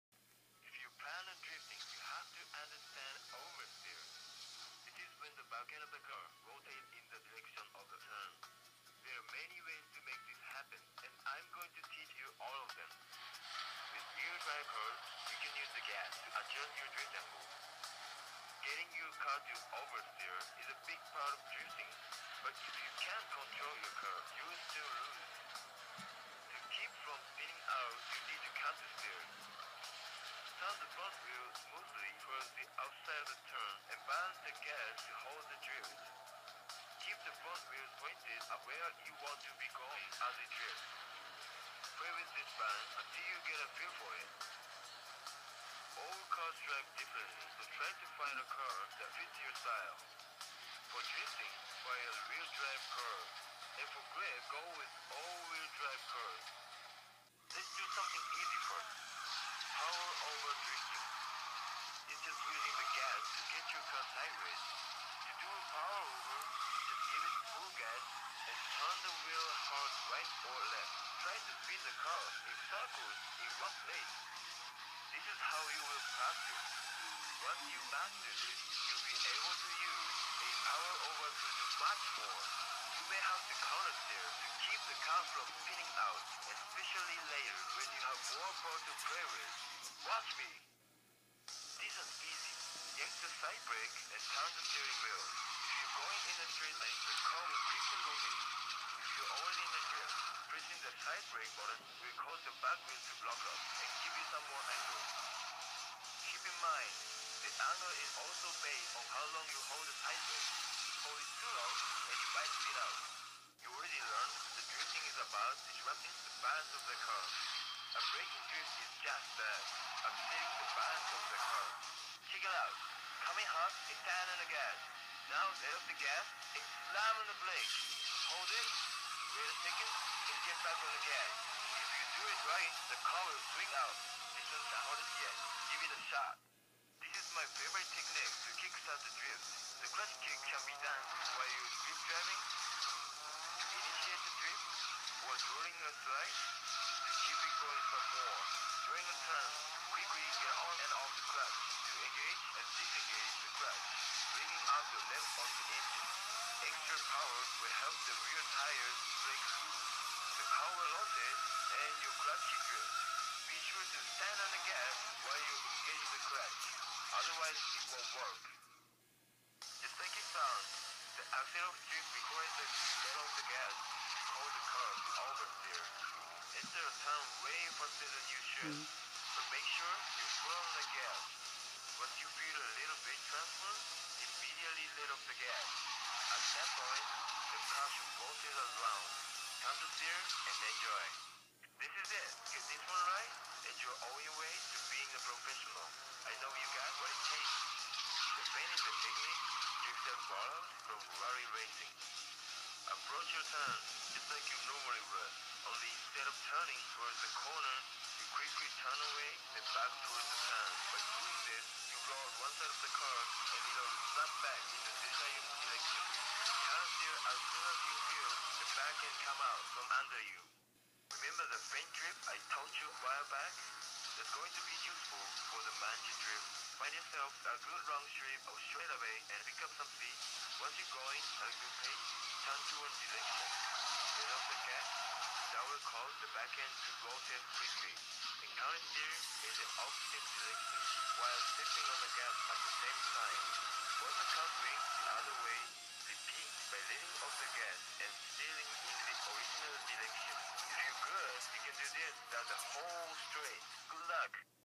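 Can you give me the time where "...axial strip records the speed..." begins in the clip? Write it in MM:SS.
02:51.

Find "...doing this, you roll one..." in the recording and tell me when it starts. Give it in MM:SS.
03:31.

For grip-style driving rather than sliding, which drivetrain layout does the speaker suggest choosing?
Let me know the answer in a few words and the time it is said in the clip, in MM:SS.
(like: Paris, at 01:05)
all-wheel drive, at 00:55.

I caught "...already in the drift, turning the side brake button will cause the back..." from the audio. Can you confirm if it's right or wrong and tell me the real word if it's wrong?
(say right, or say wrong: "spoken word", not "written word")
wrong: "pressing", not "turning".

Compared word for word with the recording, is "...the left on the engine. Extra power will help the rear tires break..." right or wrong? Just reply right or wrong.
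right.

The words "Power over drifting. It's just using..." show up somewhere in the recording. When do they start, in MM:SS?
00:59.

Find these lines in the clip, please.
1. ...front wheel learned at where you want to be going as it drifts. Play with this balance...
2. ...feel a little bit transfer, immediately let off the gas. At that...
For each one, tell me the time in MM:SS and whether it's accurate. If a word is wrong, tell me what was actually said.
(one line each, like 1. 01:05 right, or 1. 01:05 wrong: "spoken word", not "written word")
1. 00:37 wrong: "pointed", not "learned"
2. 03:02 right.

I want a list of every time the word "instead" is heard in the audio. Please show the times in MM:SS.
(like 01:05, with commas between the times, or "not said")
02:56, 03:25.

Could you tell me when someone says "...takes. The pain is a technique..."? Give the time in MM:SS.
03:17.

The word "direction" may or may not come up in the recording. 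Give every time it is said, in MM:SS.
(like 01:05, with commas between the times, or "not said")
03:35, 03:52, 04:00, 04:09.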